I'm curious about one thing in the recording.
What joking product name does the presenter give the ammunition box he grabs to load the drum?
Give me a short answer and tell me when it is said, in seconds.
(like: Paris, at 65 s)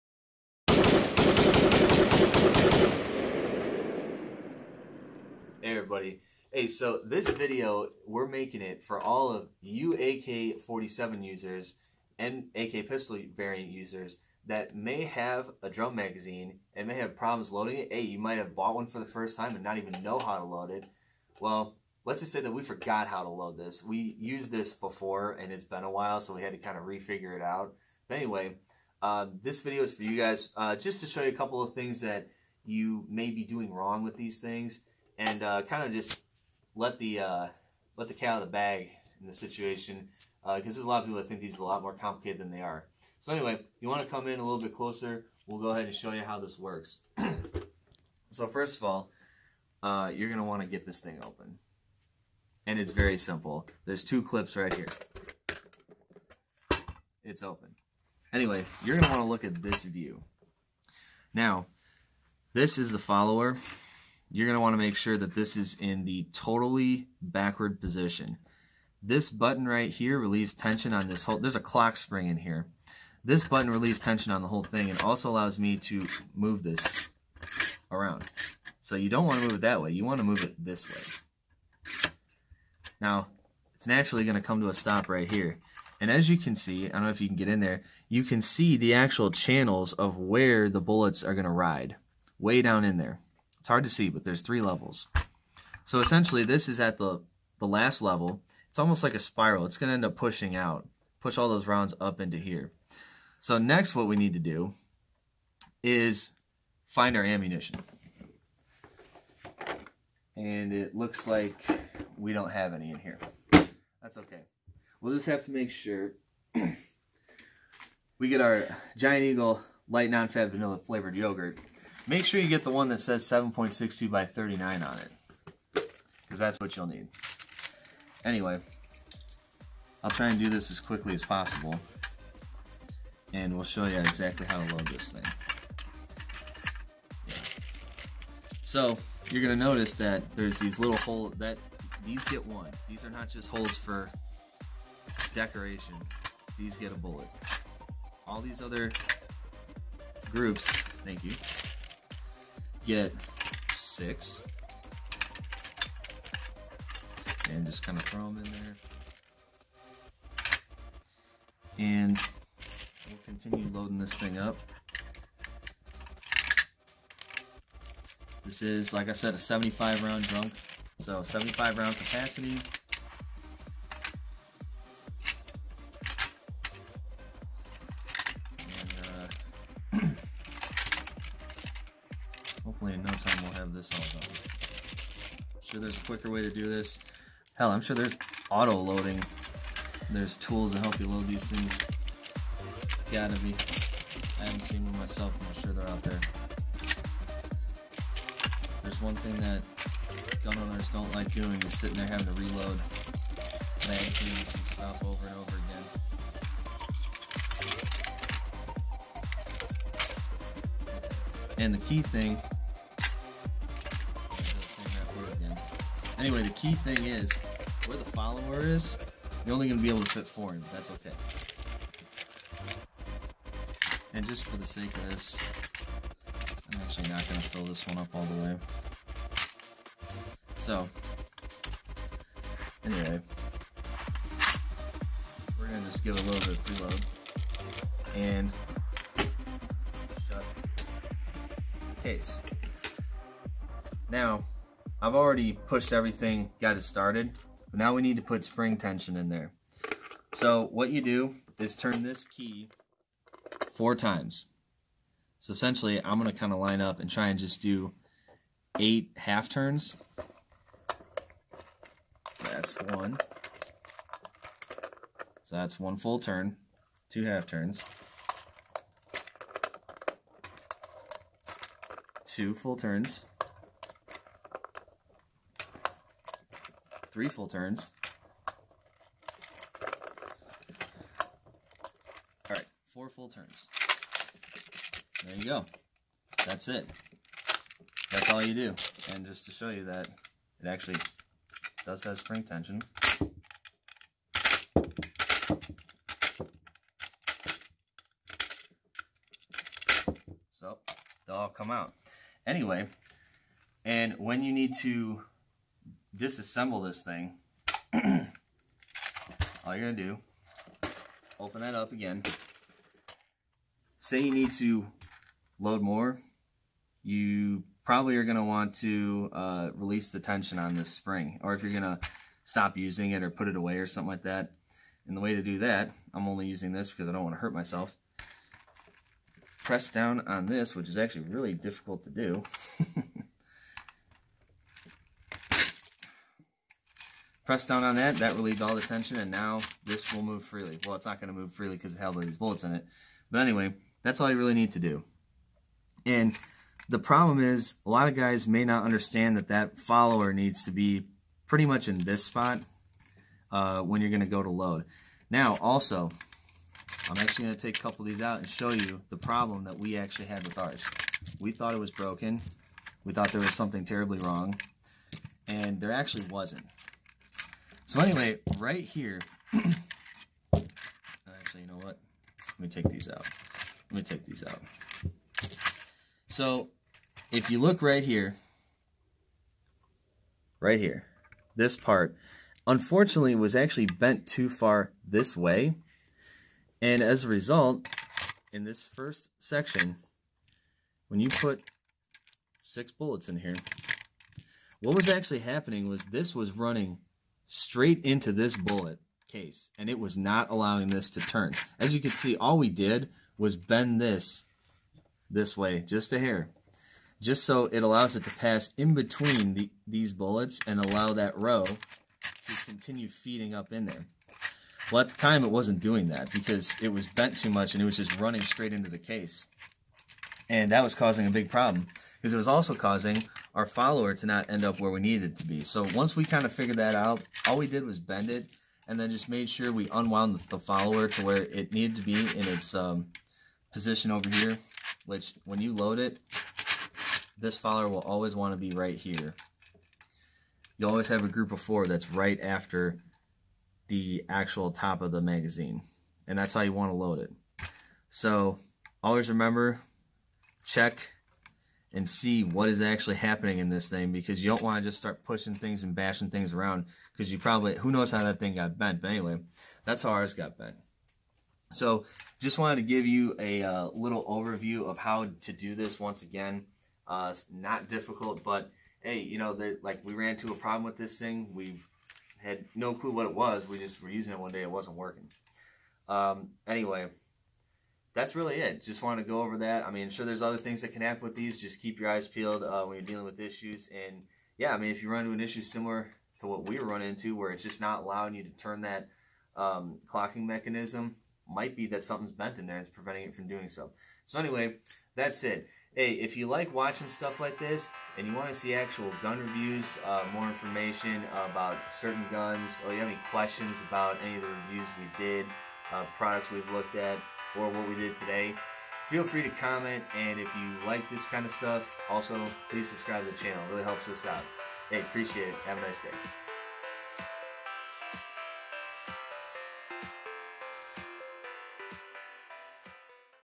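Giant Eagle light non-fat vanilla flavored yogurt, at 118 s.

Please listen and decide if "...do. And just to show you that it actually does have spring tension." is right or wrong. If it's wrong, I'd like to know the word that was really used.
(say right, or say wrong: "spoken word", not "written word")
right.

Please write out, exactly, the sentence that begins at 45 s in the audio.
We'll go ahead and show you how this works.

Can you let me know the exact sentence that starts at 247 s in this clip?
But now we need to put spring tension in there.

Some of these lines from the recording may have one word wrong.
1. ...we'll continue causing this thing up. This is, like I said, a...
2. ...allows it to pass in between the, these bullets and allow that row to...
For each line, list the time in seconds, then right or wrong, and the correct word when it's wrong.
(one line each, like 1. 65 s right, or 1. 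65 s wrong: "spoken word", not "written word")
1. 163 s wrong: "loading", not "causing"
2. 407 s right.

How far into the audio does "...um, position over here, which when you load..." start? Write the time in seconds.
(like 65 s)
432 s.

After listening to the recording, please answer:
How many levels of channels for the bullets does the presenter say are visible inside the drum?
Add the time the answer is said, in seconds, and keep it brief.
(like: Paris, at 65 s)
3, at 94 s.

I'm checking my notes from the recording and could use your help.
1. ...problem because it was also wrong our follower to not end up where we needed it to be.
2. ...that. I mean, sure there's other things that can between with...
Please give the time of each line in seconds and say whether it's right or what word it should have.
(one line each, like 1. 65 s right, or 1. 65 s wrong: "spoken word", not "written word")
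1. 421 s wrong: "causing", not "wrong"
2. 479 s wrong: "happen", not "between".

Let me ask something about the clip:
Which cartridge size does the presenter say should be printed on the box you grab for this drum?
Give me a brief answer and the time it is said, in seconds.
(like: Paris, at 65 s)
7.62x39, at 123 s.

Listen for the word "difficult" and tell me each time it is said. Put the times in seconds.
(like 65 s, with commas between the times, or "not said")
331 s, 467 s.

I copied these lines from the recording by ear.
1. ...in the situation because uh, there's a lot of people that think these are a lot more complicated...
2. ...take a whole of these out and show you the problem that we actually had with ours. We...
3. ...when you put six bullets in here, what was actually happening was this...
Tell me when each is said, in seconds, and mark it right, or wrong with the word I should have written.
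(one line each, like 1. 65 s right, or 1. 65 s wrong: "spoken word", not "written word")
1. 39 s right
2. 357 s wrong: "couple", not "whole"
3. 391 s right.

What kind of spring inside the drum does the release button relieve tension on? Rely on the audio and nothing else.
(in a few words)
clock spring.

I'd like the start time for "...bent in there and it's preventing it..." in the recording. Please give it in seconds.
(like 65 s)
492 s.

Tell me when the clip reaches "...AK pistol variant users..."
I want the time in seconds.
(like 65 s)
12 s.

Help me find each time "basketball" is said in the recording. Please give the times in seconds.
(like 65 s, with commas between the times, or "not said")
not said.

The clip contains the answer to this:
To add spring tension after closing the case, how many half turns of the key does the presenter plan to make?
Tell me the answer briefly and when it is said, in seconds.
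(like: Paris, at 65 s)
8, at 258 s.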